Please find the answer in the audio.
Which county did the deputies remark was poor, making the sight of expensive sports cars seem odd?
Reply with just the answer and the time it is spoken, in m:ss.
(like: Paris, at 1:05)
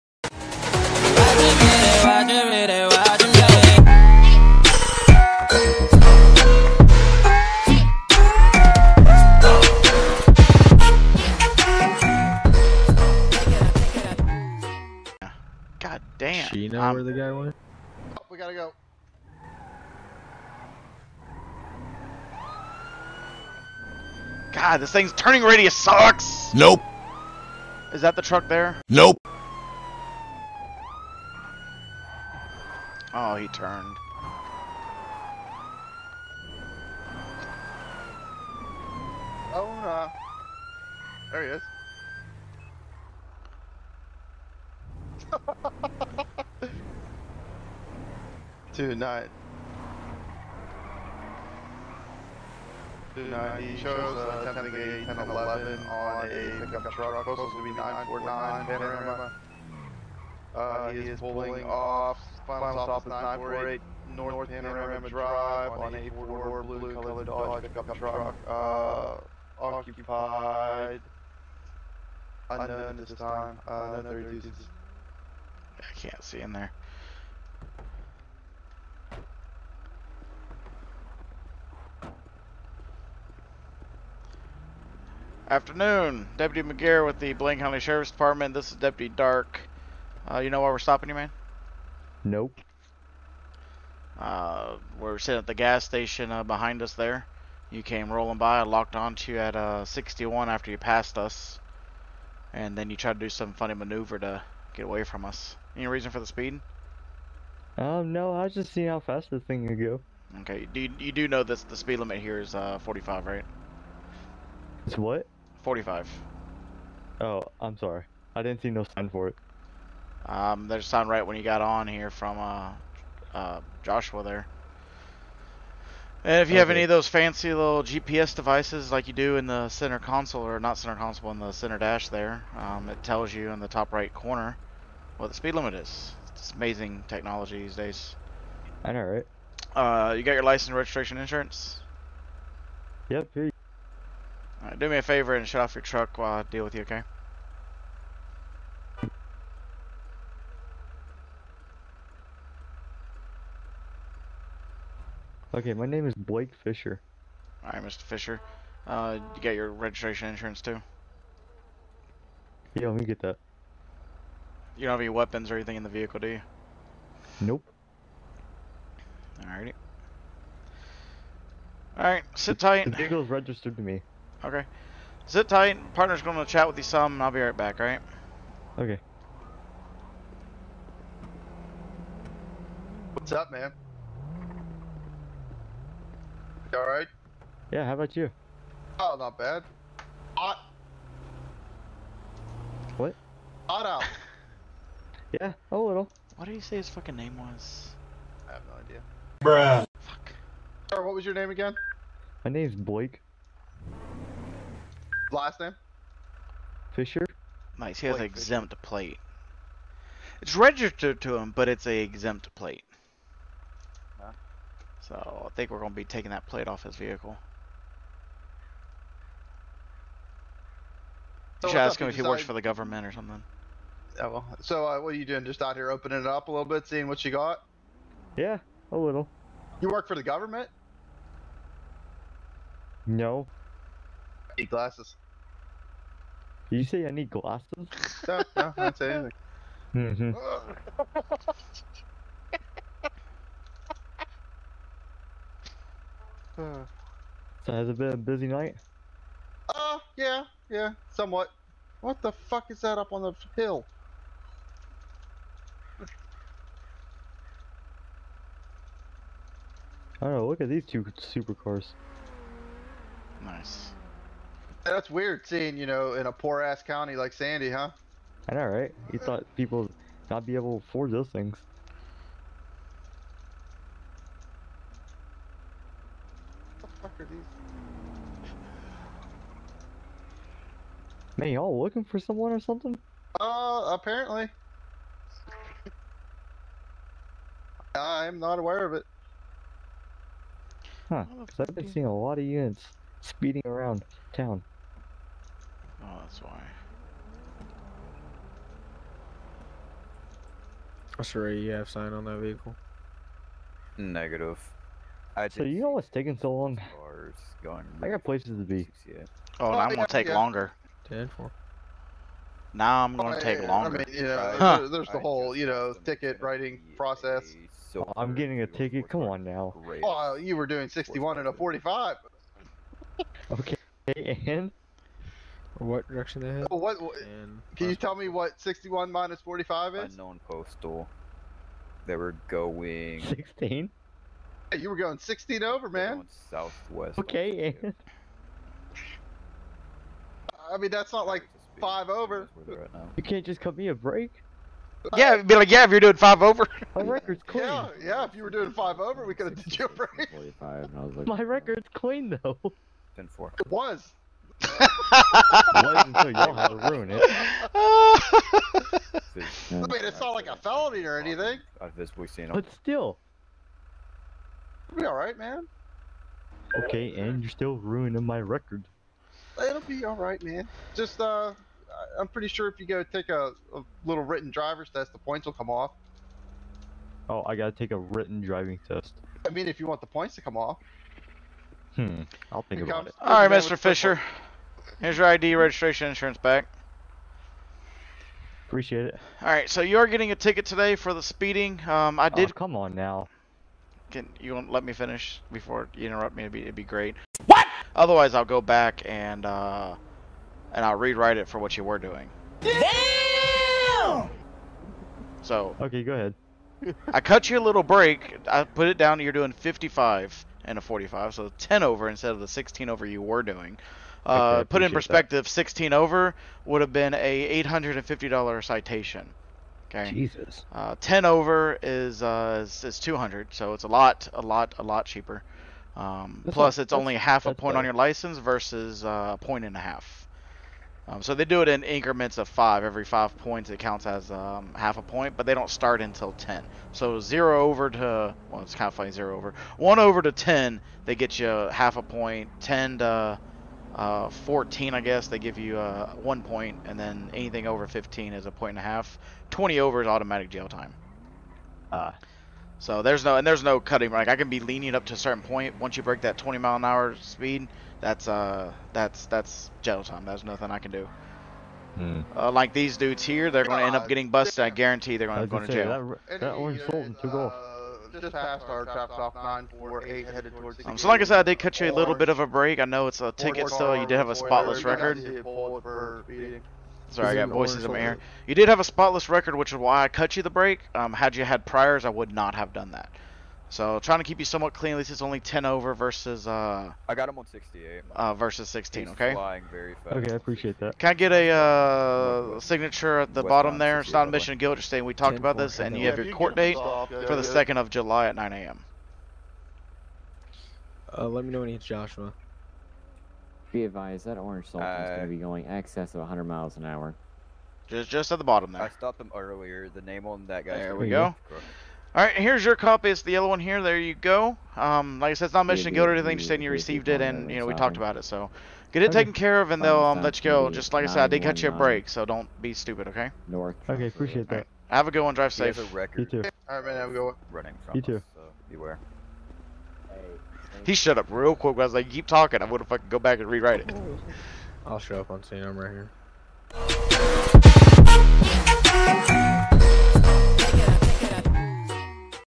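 Sandy, at 4:27.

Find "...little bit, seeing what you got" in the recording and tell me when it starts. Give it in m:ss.
3:46.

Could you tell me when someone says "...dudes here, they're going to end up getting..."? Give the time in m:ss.
7:42.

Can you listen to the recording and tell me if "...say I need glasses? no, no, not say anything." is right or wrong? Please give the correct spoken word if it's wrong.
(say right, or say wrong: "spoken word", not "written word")
right.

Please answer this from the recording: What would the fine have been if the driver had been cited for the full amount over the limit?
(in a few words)
$850.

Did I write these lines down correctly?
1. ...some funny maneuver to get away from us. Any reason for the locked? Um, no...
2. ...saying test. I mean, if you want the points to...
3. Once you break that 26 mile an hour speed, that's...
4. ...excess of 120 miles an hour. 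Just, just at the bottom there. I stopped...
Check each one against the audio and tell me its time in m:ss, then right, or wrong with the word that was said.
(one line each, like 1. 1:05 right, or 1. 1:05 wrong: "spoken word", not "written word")
1. 1:43 wrong: "speed", not "locked"
2. 6:18 wrong: "driving", not "saying"
3. 7:35 wrong: "20", not "26"
4. 8:25 wrong: "100", not "120".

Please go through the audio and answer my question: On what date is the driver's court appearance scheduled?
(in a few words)
2nd of July.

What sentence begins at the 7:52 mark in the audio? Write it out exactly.
I know it's a ticket still.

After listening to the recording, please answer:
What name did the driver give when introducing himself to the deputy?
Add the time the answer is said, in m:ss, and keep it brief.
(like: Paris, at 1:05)
Blake Fisher, at 2:36.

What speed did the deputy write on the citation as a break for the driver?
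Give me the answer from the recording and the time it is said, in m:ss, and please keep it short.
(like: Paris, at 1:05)
55, at 6:49.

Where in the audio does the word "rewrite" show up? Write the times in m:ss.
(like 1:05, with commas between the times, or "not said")
6:40, 8:53.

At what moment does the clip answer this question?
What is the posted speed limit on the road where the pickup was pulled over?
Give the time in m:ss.
1:52.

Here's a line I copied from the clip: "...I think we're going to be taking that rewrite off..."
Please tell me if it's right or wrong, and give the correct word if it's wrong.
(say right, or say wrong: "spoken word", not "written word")
wrong: "plate", not "rewrite".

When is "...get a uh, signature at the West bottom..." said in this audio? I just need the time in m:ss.
8:11.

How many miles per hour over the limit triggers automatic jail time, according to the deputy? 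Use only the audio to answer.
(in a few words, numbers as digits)
20.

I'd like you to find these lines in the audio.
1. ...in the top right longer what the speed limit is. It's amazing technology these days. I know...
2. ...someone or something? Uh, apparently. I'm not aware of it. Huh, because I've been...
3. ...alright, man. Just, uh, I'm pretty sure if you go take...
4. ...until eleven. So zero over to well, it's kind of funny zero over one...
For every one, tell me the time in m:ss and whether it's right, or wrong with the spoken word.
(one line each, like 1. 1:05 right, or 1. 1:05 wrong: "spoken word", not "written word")
1. 2:13 wrong: "corner", not "longer"
2. 4:42 right
3. 6:10 right
4. 7:16 wrong: "ten", not "eleven".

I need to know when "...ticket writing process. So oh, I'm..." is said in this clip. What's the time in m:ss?
5:16.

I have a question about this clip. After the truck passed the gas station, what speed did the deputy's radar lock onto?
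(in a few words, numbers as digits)
61.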